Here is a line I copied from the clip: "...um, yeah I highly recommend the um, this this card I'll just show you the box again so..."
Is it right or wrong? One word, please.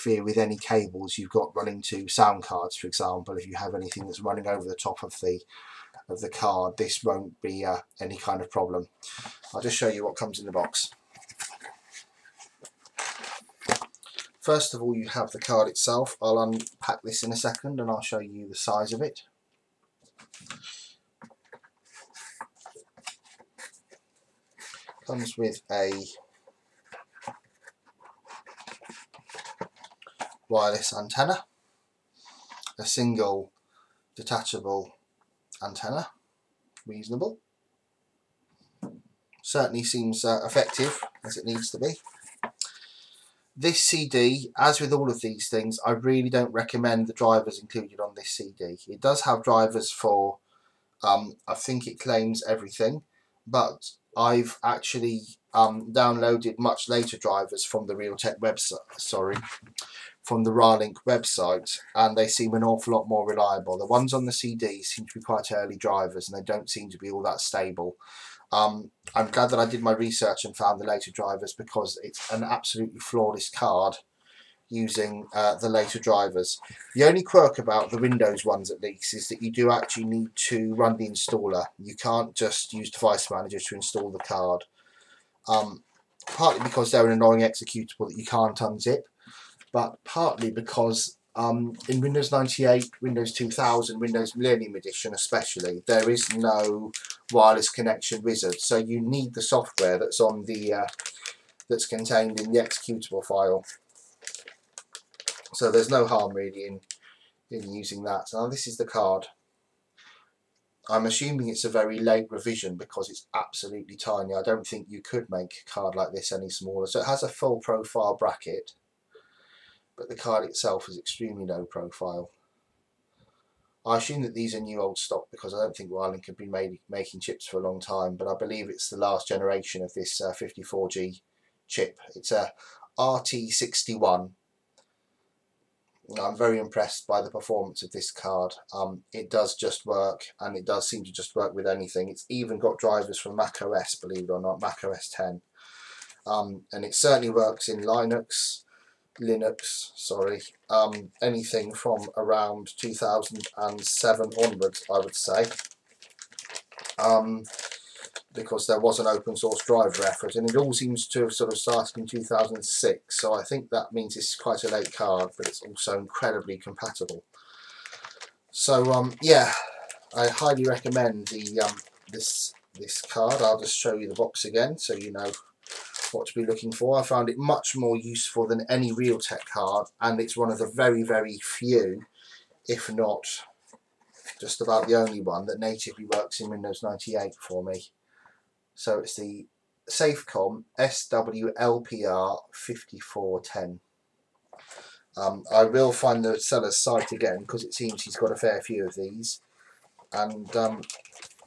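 right.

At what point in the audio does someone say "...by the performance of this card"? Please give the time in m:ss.
2:17.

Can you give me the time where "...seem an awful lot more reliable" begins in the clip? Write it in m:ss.
1:02.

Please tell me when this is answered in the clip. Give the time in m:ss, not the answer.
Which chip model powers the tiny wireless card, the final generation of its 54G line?
2:12.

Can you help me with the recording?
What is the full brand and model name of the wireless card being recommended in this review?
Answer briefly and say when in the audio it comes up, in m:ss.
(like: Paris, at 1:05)
Safecom SWLPR 5410, at 3:09.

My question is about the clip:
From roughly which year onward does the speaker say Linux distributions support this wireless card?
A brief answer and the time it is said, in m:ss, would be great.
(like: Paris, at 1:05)
2007, at 2:32.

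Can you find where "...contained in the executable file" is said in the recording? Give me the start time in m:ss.
1:41.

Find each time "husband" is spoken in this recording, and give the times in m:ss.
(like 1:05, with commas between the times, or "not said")
not said.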